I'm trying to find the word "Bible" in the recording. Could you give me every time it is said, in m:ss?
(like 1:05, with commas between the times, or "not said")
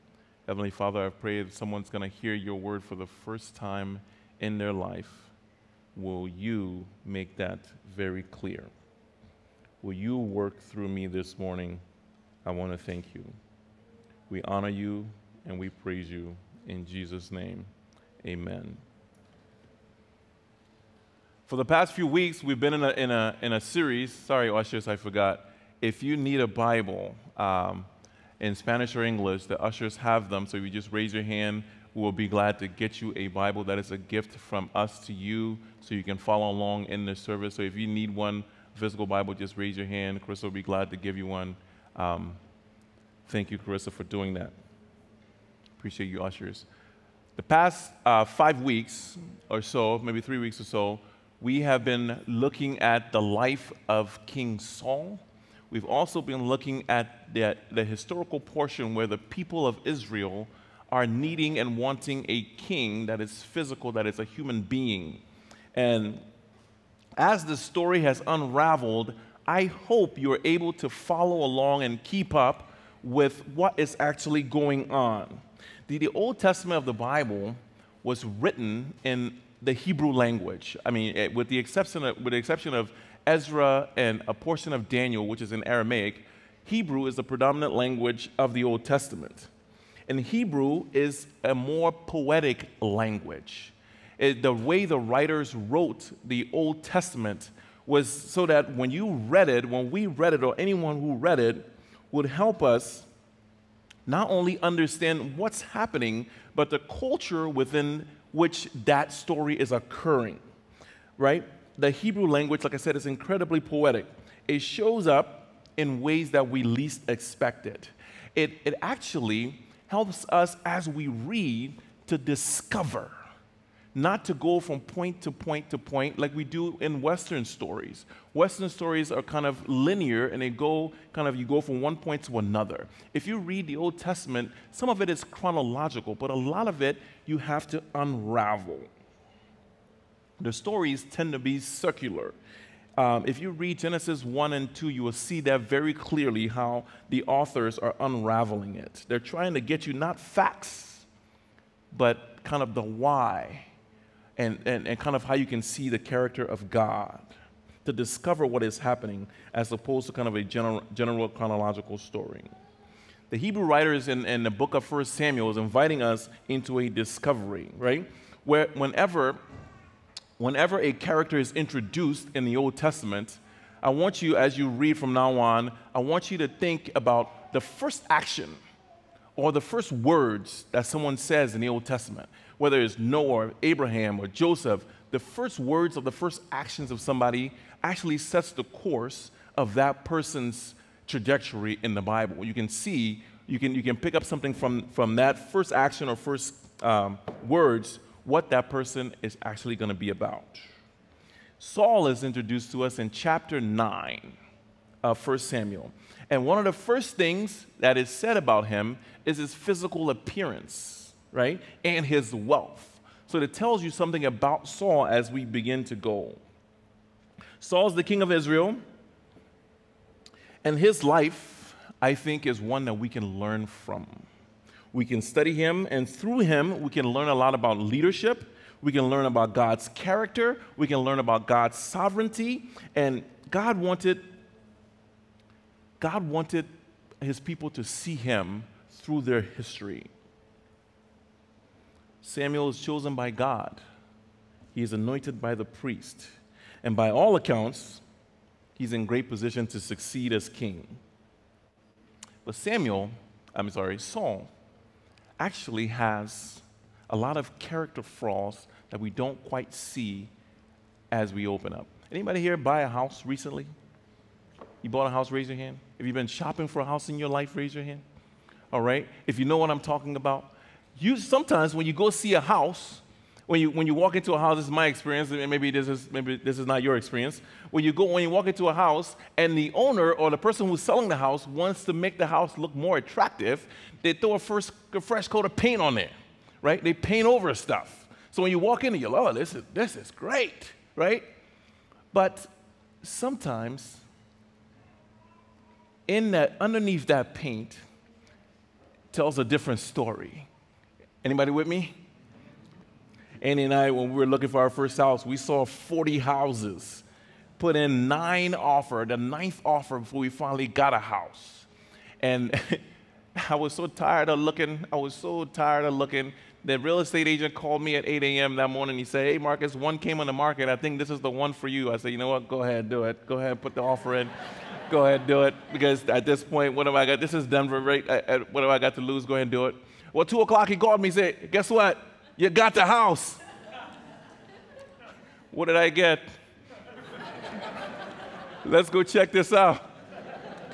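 0:26, 0:33, 0:39, 1:16, 3:12.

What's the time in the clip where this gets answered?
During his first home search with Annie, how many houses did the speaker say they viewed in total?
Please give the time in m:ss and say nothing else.
5:05.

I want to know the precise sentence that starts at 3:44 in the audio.
We can study him, and through him, we can learn a lot about leadership.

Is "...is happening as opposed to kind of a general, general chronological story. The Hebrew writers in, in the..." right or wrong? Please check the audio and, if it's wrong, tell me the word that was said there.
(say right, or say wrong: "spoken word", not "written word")
right.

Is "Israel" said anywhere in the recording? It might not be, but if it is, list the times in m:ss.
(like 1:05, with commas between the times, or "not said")
0:59, 3:38.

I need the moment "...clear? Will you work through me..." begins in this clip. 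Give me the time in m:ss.
0:08.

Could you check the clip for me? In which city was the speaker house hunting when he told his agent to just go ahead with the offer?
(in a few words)
Denver.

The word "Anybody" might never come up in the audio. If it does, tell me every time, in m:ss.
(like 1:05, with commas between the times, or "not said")
4:22, 5:01.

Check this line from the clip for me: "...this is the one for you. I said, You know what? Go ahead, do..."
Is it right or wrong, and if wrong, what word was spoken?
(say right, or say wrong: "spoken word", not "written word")
right.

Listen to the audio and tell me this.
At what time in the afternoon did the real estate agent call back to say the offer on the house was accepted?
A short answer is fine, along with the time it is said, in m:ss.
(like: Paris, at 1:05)
2 o'clock, at 5:30.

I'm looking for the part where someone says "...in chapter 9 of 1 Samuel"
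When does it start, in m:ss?
3:22.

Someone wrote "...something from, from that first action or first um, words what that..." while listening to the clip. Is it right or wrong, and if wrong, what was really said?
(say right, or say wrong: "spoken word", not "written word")
right.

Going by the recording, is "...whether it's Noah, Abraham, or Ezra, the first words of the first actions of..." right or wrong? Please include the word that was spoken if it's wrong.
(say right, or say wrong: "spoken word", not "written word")
wrong: "Joseph", not "Ezra".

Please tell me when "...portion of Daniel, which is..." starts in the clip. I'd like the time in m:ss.
1:24.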